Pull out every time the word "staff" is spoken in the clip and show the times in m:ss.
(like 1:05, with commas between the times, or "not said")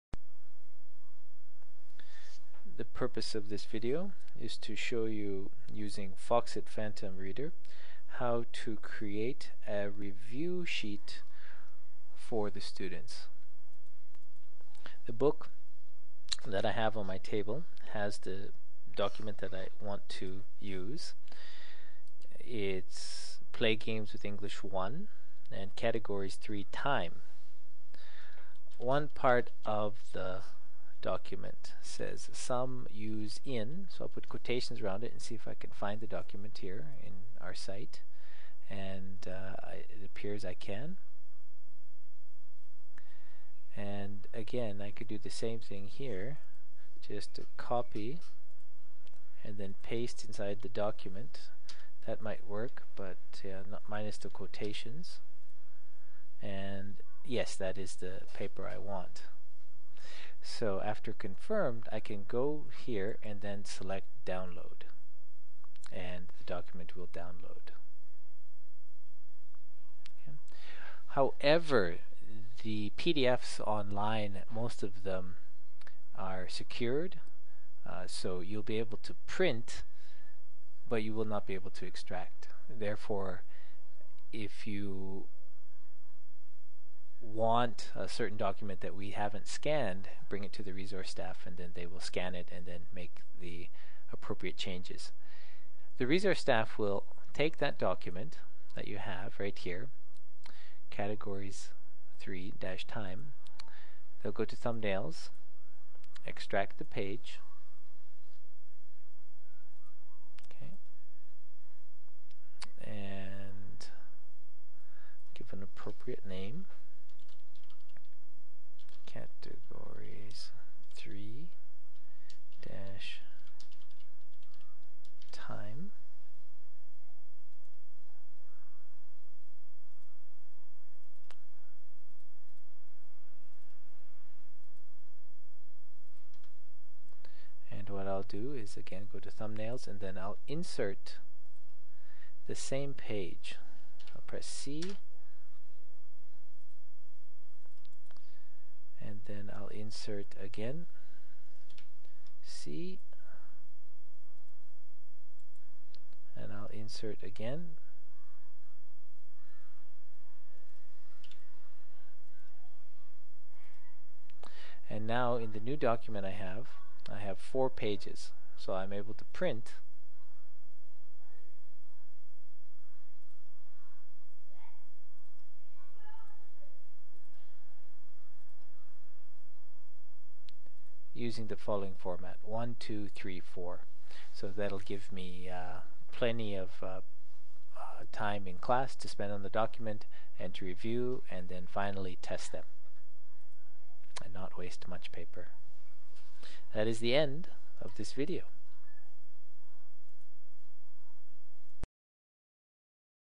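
1:31, 1:36.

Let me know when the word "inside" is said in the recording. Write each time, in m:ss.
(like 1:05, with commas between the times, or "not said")
0:50.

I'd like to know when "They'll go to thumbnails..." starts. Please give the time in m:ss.
1:44.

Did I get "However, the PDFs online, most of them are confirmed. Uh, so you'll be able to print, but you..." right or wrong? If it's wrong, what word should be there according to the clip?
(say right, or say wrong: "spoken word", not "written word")
wrong: "secured", not "confirmed".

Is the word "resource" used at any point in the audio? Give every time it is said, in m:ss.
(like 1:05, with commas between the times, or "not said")
1:30, 1:36.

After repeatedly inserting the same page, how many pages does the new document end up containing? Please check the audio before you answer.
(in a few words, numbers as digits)
4.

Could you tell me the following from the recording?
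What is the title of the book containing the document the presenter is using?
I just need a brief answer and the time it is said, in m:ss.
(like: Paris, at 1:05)
Play Games with English 1, at 0:23.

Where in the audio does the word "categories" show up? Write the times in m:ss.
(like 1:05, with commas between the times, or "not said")
0:25, 1:40, 1:59.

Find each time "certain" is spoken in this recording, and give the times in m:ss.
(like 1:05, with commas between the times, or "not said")
1:28.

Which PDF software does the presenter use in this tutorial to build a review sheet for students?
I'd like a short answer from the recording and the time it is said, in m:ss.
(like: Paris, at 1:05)
Foxit Phantom Reader, at 0:06.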